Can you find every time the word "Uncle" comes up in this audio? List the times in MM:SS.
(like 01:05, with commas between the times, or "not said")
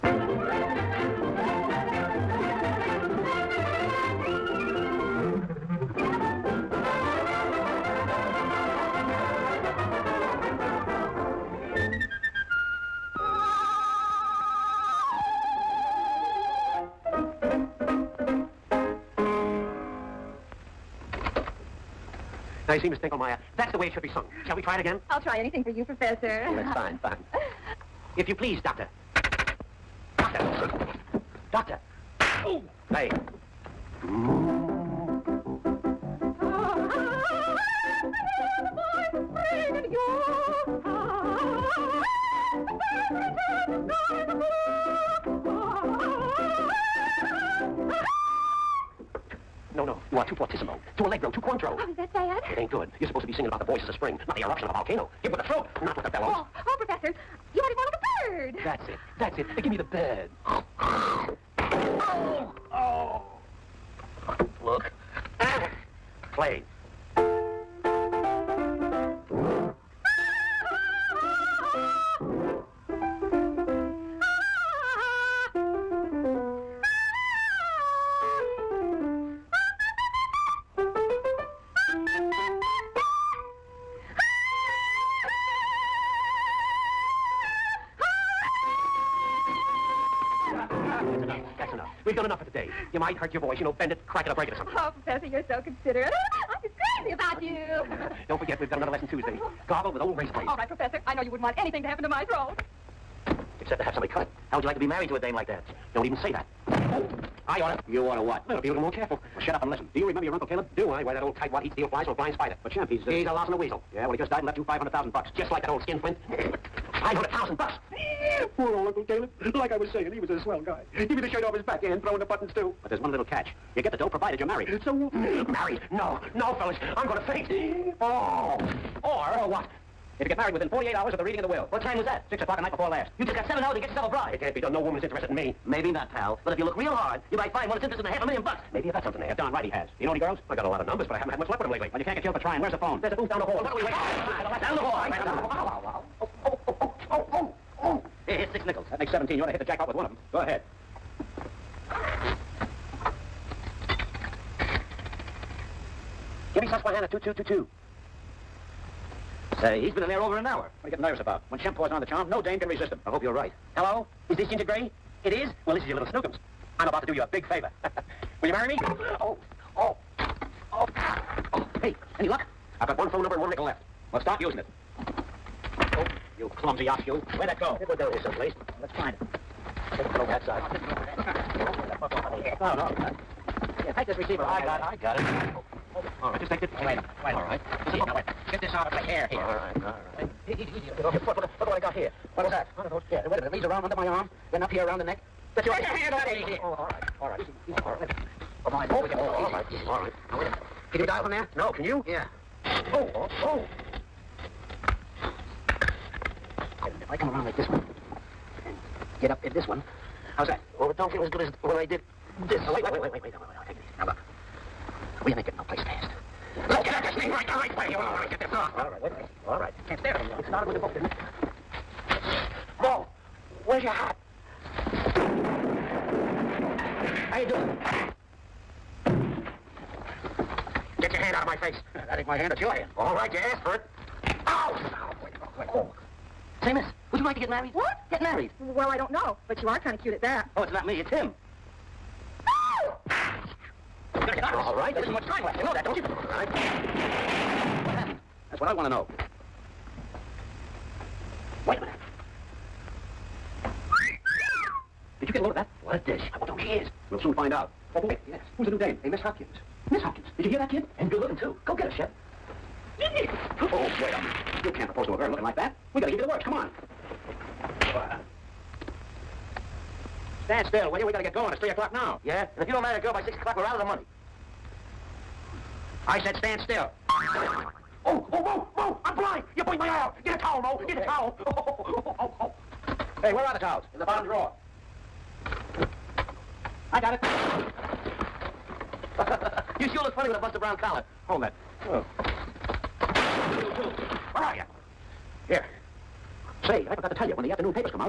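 01:50, 01:58.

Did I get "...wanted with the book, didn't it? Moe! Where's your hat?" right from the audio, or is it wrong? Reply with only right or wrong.
wrong.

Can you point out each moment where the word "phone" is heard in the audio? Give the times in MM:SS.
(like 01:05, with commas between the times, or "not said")
02:22, 02:53.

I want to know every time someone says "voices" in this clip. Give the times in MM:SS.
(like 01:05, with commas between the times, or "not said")
00:53, 01:33.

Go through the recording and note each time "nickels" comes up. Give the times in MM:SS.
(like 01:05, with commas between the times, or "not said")
02:28, 02:53.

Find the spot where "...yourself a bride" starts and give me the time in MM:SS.
02:13.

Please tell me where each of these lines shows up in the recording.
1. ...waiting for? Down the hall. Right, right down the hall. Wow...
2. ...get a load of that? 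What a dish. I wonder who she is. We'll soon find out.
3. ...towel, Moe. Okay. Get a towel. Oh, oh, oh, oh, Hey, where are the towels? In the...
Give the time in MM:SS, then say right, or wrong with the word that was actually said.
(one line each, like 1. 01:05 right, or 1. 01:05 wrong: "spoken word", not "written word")
1. 02:23 right
2. 04:15 right
3. 04:40 right.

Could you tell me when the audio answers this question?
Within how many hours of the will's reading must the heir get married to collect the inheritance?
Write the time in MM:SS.
02:10.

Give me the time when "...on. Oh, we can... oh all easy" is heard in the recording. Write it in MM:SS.
03:18.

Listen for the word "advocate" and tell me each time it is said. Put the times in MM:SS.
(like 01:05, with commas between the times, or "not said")
not said.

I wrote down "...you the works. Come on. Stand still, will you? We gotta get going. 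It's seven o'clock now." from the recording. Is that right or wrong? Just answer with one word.
wrong.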